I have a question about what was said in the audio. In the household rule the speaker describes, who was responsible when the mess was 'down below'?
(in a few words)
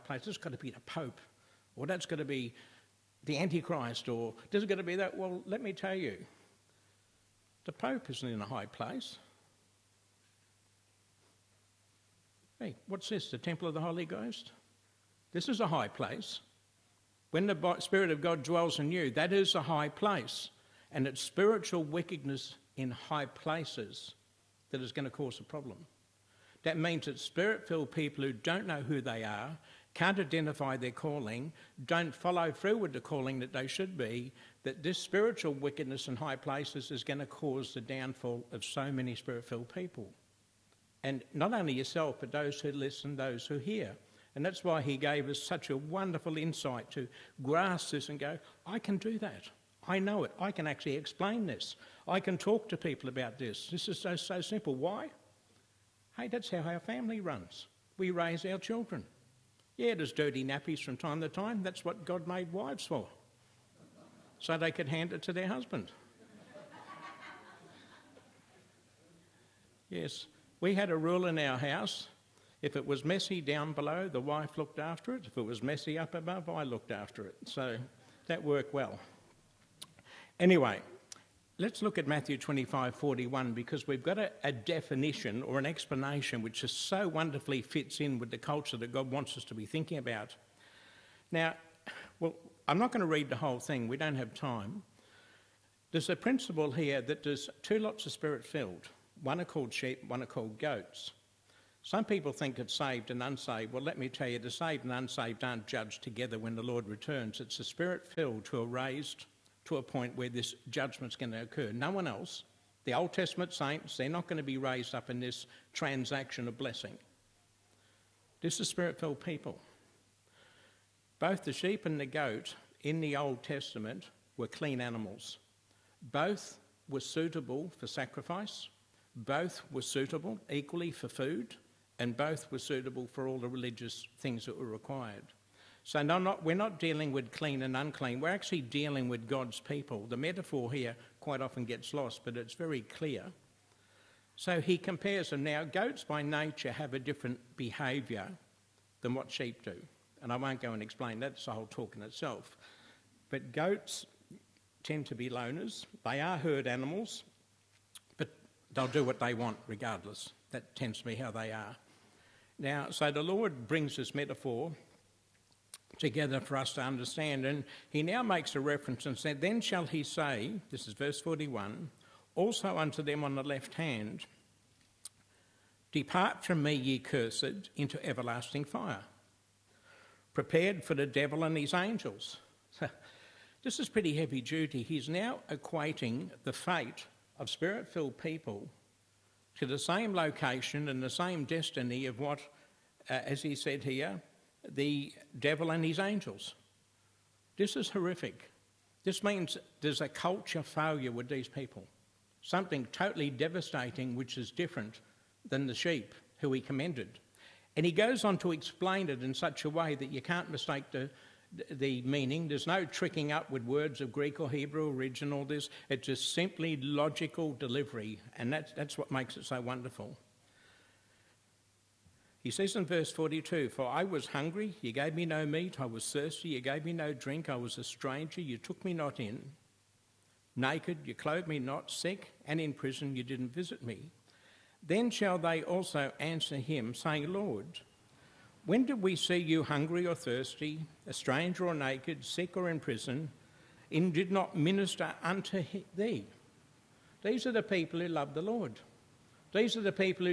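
The wife.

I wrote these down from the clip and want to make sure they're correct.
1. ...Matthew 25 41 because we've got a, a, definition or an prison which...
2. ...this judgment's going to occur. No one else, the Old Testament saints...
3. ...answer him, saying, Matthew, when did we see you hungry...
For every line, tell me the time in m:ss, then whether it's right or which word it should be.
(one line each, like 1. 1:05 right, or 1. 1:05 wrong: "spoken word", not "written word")
1. 1:22 wrong: "explanation", not "prison"
2. 1:50 right
3. 3:56 wrong: "Lord", not "Matthew".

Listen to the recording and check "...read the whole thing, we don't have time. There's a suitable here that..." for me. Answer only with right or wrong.
wrong.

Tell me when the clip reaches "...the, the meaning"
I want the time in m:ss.
3:30.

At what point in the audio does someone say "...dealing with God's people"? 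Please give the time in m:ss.
2:18.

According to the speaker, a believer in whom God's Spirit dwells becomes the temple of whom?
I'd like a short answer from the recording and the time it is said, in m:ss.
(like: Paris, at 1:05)
The Holy Ghost, at 0:13.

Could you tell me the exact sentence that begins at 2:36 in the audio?
They are herd animals, but they'll do what they want regardless.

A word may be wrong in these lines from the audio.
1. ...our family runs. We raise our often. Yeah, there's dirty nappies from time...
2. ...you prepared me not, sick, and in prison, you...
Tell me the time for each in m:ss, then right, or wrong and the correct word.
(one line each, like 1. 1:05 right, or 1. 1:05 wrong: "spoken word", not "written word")
1. 0:56 wrong: "children", not "often"
2. 3:51 wrong: "clothed", not "prepared".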